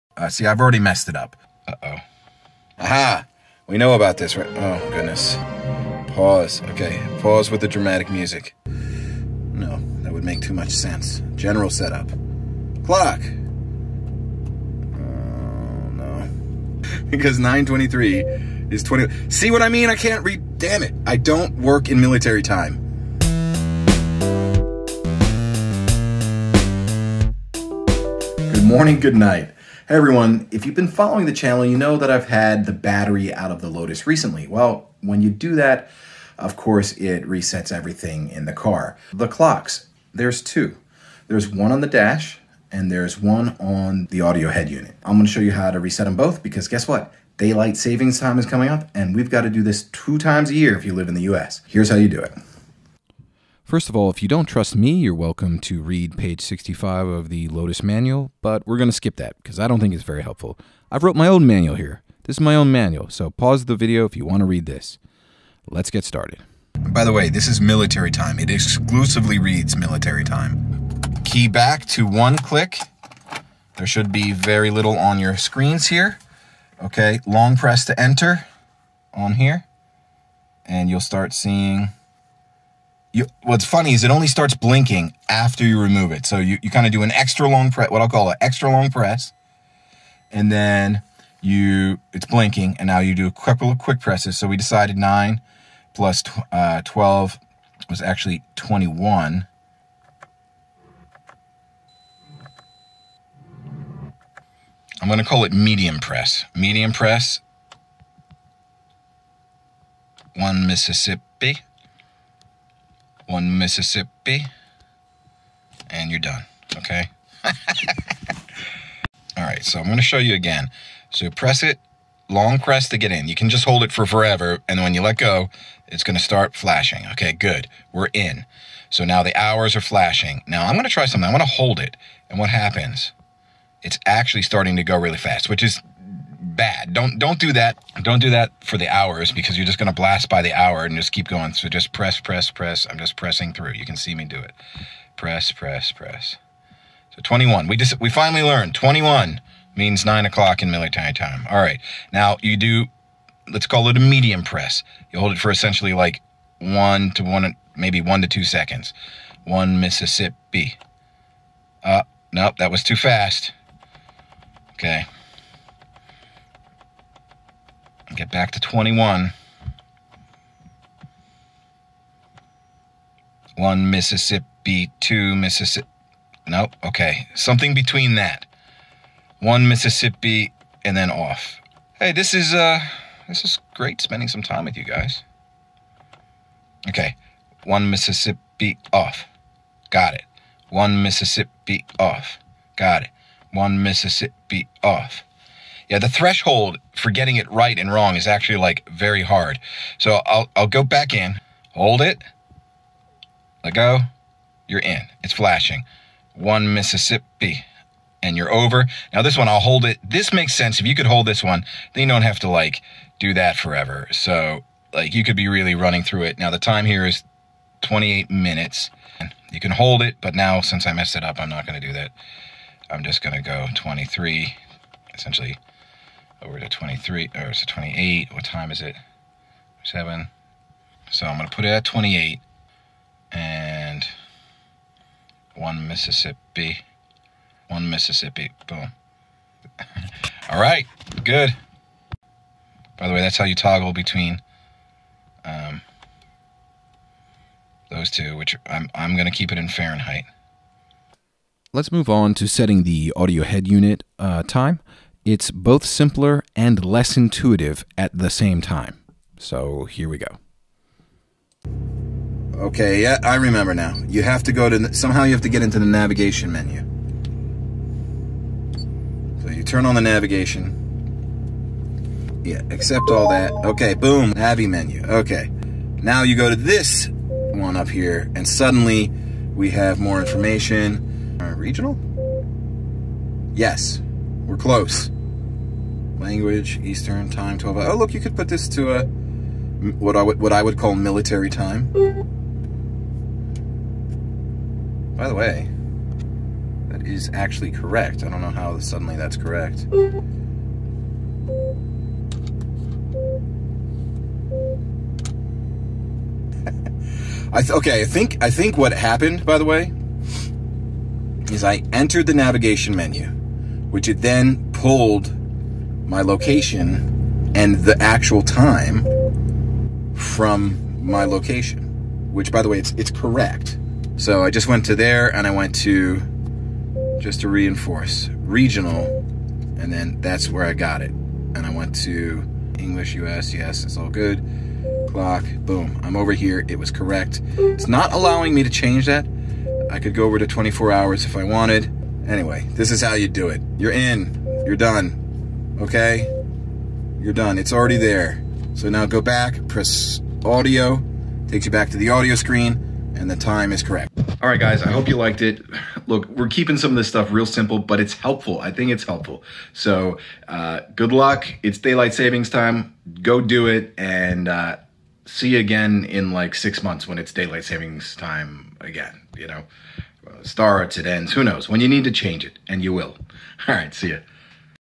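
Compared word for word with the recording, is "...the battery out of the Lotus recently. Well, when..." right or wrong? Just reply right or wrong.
right.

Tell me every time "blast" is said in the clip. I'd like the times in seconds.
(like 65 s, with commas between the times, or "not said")
139 s.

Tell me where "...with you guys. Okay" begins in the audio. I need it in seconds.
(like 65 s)
184 s.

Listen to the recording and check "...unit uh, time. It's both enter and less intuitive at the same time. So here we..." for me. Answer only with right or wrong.
wrong.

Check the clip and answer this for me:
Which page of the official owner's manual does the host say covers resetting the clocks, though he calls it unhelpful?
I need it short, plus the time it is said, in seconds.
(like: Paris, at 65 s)
65, at 56 s.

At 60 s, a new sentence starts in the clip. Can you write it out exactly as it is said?
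I've wrote my own manual here.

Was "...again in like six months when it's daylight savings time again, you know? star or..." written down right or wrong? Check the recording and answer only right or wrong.
right.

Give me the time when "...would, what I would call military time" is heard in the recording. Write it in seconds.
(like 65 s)
290 s.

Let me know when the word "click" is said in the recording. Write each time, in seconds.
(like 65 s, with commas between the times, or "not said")
72 s.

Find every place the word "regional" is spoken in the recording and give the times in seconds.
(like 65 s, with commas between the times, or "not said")
281 s, 328 s.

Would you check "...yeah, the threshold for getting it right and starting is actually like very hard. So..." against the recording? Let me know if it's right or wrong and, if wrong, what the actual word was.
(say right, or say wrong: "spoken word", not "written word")
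wrong: "wrong", not "starting".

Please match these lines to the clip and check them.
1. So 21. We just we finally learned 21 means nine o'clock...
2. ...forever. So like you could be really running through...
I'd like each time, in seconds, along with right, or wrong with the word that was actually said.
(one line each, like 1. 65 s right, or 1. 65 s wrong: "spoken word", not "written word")
1. 147 s right
2. 213 s right.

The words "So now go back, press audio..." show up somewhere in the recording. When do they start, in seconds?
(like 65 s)
348 s.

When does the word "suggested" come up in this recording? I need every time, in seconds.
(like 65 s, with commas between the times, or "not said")
not said.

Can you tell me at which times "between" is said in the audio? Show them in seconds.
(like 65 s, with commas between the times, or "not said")
177 s, 243 s.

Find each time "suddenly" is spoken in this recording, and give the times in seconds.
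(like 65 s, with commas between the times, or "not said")
278 s, 298 s.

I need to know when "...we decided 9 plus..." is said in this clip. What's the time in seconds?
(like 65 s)
94 s.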